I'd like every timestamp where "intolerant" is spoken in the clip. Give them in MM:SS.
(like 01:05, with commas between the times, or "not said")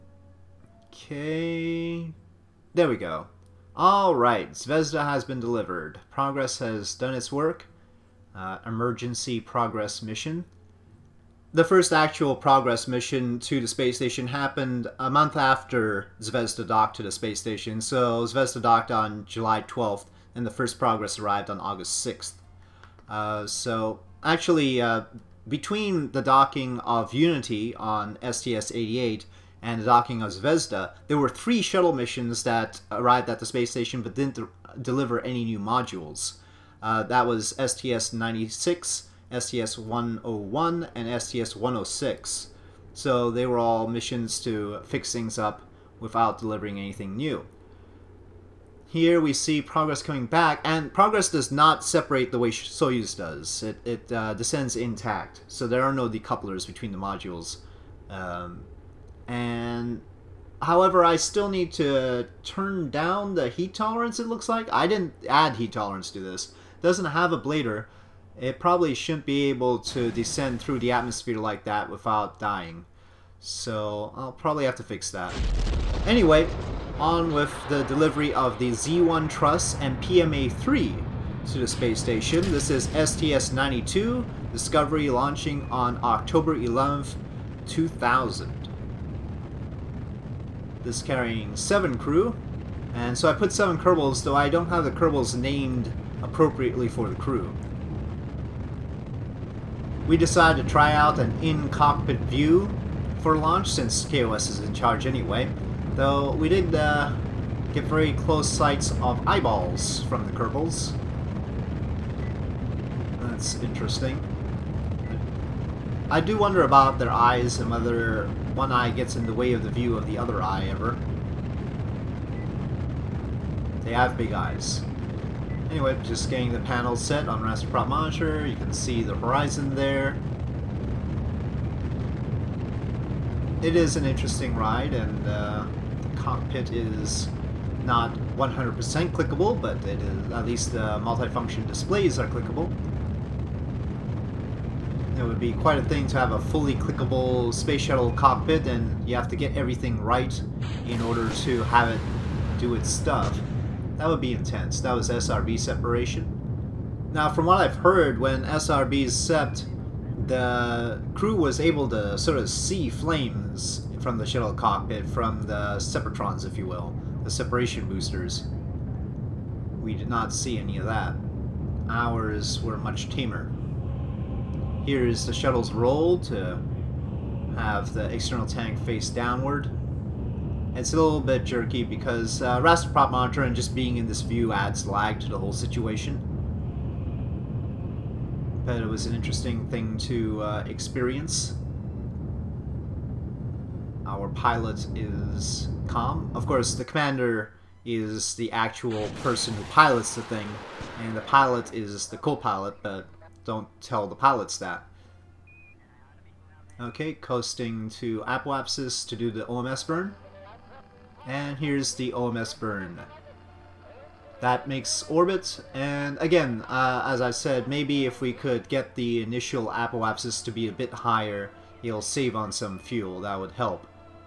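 not said.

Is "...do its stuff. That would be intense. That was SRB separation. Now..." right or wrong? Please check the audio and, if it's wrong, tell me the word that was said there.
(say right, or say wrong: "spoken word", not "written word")
right.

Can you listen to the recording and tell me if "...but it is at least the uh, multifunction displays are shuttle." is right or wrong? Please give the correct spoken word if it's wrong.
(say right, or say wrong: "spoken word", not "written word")
wrong: "clickable", not "shuttle".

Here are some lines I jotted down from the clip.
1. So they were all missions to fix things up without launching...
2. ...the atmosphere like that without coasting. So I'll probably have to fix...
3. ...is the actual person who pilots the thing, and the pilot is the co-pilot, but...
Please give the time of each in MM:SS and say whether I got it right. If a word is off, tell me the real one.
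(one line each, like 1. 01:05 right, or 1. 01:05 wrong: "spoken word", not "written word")
1. 00:42 wrong: "delivering", not "launching"
2. 01:10 wrong: "dying", not "coasting"
3. 03:17 right.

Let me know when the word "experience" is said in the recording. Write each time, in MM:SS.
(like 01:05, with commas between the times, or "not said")
03:10.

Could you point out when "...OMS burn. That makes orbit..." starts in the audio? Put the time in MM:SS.
03:32.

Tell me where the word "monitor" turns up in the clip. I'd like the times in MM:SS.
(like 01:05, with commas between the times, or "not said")
02:07, 03:03.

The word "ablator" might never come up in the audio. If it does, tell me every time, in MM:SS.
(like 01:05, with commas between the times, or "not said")
01:07.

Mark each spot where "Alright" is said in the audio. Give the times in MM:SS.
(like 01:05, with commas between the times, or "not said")
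00:03.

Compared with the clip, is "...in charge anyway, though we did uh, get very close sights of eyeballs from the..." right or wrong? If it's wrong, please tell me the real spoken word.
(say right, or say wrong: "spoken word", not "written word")
right.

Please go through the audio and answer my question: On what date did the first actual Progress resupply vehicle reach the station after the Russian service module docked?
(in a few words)
August 6th.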